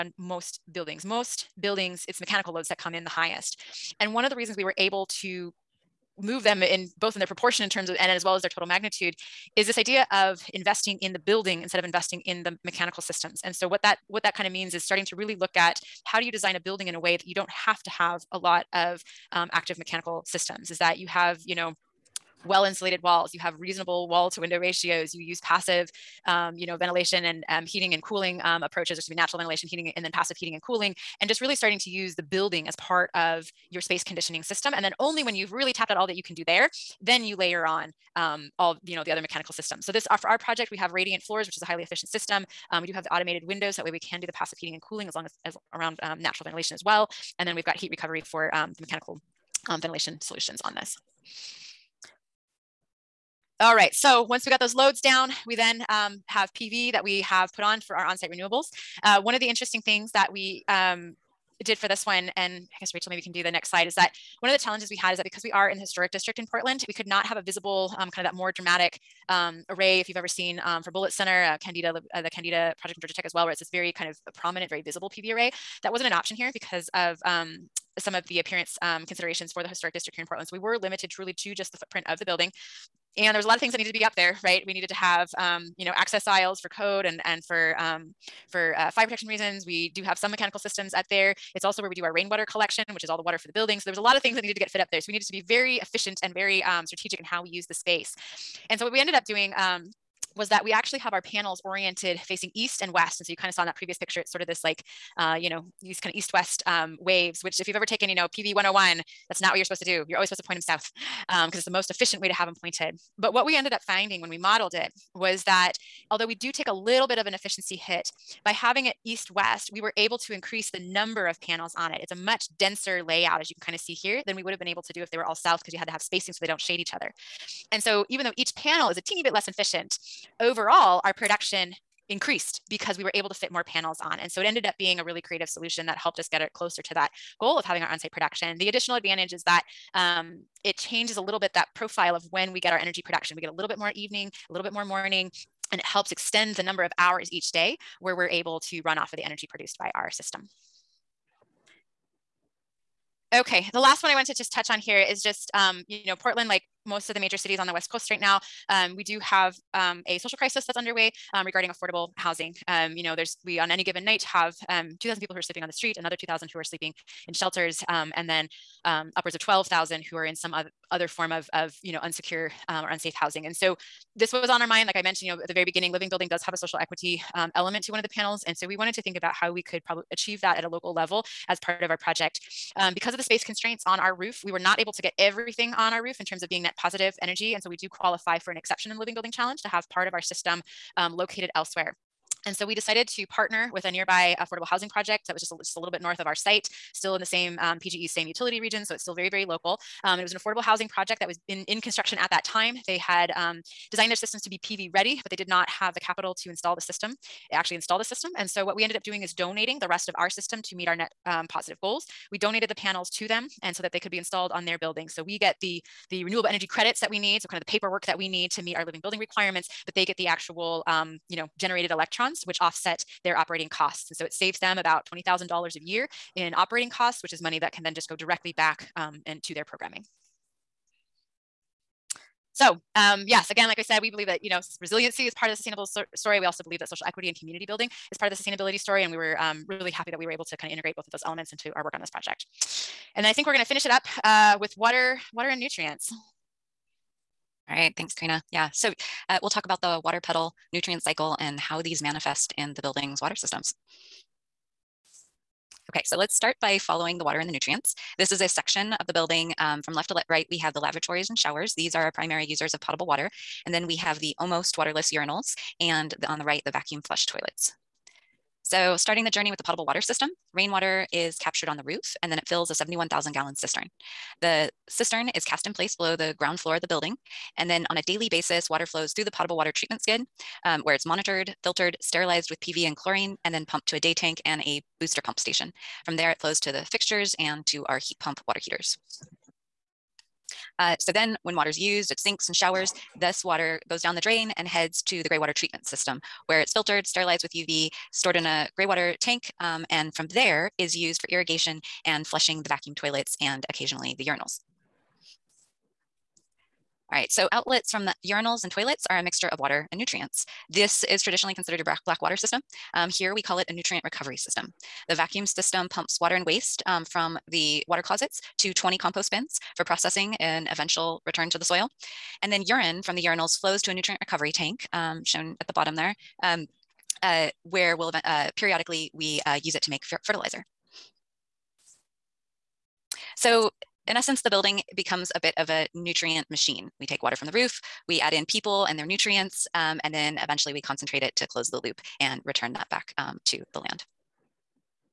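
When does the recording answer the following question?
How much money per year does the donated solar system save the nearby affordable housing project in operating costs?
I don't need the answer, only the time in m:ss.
3:45.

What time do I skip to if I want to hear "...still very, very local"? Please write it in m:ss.
3:19.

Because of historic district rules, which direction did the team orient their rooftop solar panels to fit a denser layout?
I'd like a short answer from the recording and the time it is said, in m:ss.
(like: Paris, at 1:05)
east and west, at 1:42.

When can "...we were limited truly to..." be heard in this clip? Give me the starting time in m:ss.
1:20.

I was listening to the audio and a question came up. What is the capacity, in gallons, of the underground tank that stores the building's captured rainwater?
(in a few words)
71,000 gallons.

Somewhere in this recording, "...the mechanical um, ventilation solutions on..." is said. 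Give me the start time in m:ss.
0:48.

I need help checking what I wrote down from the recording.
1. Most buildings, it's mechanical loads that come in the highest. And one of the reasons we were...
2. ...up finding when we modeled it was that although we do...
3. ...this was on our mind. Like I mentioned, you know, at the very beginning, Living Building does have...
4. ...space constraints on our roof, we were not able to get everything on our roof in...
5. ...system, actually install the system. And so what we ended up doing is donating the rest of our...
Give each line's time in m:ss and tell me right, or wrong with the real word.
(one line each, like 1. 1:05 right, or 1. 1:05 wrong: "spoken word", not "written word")
1. 0:01 right
2. 1:53 right
3. 2:54 right
4. 3:03 right
5. 3:26 right.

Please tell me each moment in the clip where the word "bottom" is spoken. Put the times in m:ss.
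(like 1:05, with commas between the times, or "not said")
5:25.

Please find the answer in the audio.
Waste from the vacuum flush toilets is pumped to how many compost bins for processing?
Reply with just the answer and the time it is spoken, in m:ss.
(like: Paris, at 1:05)
20, at 5:18.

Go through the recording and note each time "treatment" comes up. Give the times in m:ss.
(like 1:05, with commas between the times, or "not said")
4:39, 4:55.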